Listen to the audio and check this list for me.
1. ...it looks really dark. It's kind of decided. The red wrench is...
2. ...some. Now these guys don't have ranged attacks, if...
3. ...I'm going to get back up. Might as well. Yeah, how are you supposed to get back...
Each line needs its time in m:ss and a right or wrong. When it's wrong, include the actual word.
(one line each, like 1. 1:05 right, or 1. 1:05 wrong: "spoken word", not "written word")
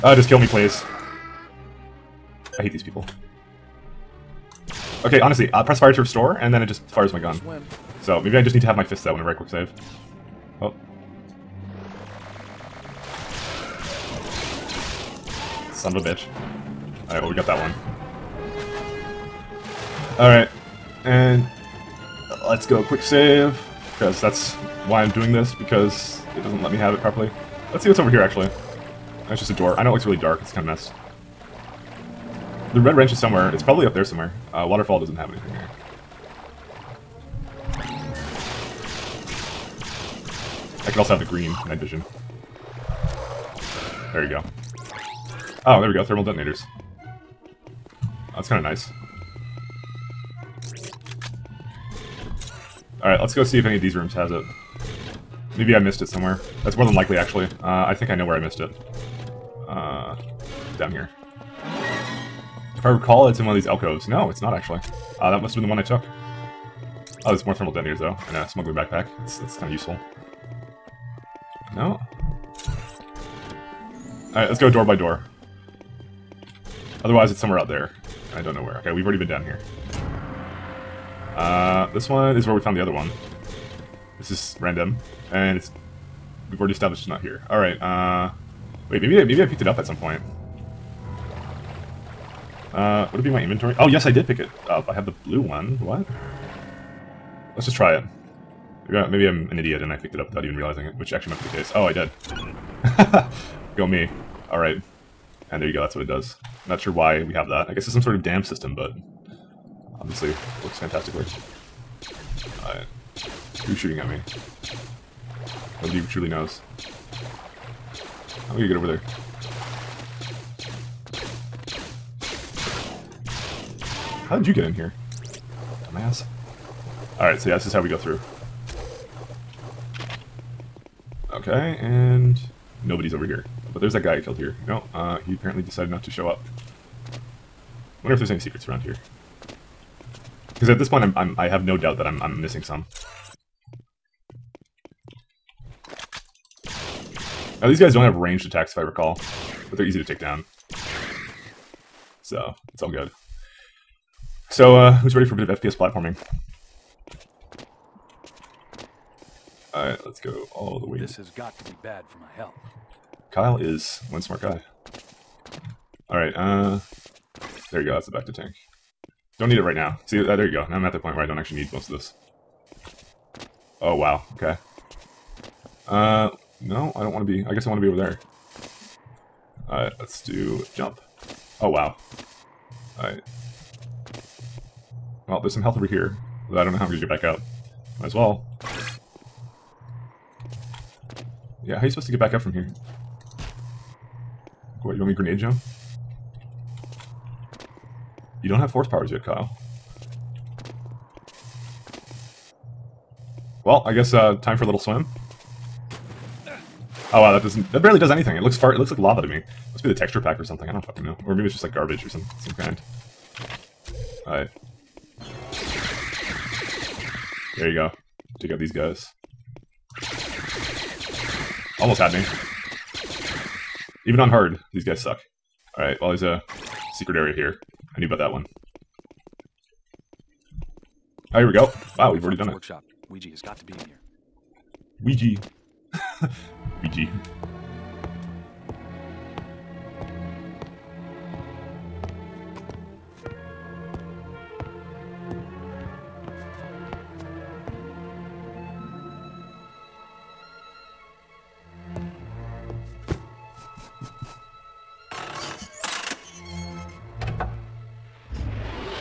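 1. 0:29 wrong: "messed", not "decided"
2. 2:22 right
3. 3:06 right.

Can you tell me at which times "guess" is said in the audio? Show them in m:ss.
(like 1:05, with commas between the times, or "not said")
1:47, 2:57, 3:23.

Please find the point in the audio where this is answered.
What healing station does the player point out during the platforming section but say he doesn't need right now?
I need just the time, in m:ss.
2:48.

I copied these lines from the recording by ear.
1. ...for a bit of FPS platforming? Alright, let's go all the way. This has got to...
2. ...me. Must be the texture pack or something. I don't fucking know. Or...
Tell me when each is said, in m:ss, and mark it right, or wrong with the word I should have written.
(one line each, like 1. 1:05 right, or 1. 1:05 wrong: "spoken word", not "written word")
1. 2:35 right
2. 3:29 right.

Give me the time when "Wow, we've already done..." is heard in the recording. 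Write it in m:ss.
3:51.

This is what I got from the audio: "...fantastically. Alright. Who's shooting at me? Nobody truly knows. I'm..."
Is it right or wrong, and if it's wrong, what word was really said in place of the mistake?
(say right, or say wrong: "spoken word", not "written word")
right.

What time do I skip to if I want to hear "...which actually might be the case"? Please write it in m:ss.
1:40.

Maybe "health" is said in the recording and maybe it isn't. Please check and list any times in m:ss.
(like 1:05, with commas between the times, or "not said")
2:42, 3:05.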